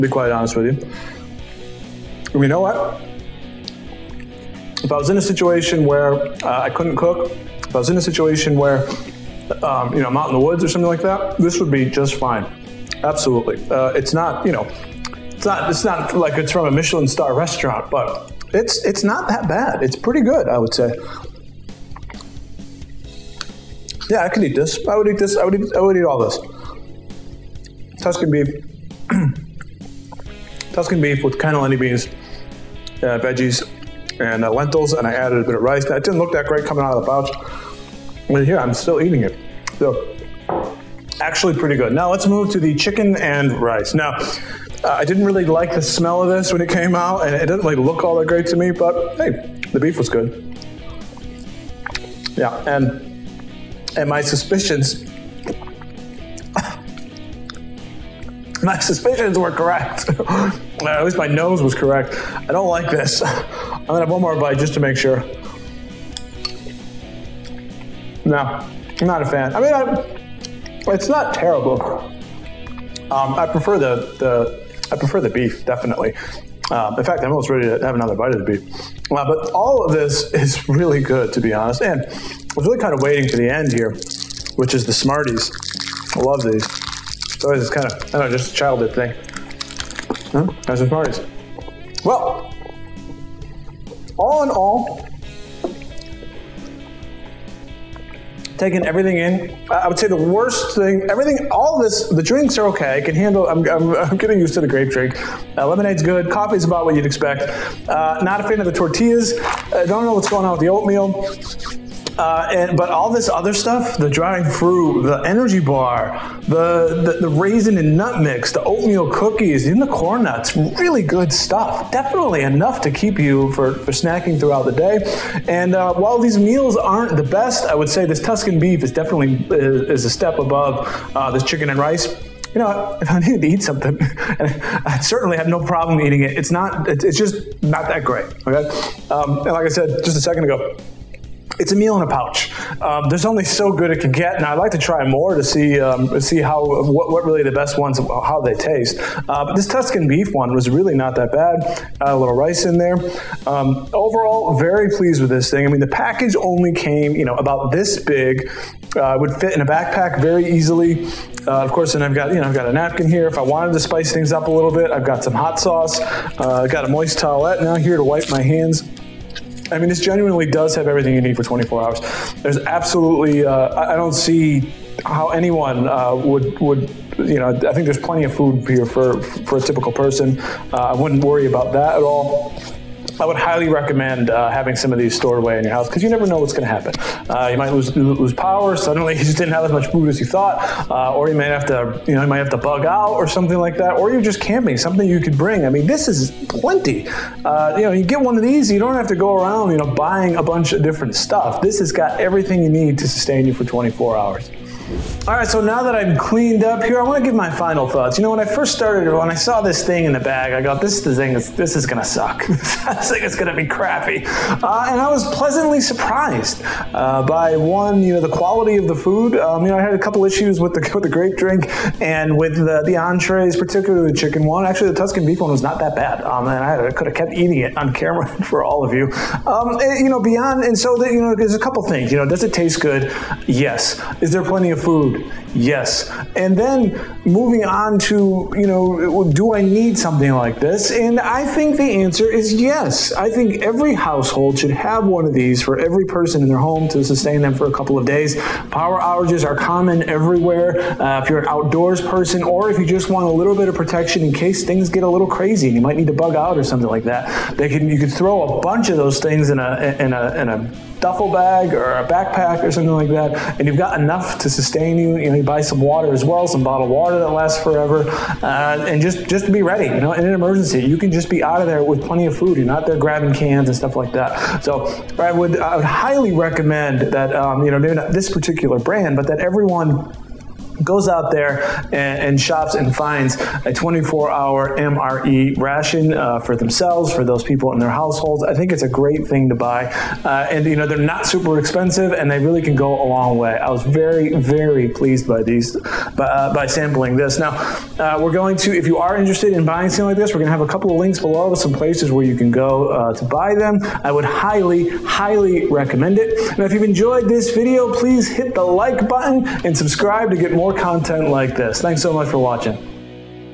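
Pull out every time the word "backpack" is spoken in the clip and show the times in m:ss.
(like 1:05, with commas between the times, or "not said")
2:39, 4:22.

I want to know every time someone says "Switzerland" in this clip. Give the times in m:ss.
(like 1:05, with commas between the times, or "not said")
not said.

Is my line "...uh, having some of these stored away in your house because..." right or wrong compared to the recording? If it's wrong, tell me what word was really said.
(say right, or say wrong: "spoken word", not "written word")
right.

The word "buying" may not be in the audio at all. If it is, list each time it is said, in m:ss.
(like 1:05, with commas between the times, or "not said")
3:19, 4:59.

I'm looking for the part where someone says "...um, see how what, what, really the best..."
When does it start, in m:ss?
2:25.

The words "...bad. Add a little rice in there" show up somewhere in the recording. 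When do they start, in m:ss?
2:31.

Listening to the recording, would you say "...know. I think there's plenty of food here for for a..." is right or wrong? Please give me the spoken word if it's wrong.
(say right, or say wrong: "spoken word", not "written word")
right.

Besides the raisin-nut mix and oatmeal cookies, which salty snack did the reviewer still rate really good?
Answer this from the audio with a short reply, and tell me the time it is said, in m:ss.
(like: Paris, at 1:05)
corn nuts, at 1:59.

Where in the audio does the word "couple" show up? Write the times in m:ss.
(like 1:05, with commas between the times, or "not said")
3:39, 3:51, 4:07, 5:00.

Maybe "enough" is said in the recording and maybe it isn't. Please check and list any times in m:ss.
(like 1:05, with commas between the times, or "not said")
2:02, 4:23.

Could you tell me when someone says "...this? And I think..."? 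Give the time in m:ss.
4:00.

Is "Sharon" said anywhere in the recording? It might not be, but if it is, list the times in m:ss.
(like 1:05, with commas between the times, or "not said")
not said.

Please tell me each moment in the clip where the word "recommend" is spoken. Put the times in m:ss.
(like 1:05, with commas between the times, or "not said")
3:03, 4:36, 5:05.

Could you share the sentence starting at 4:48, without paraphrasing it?
I think it's a great thing to buy.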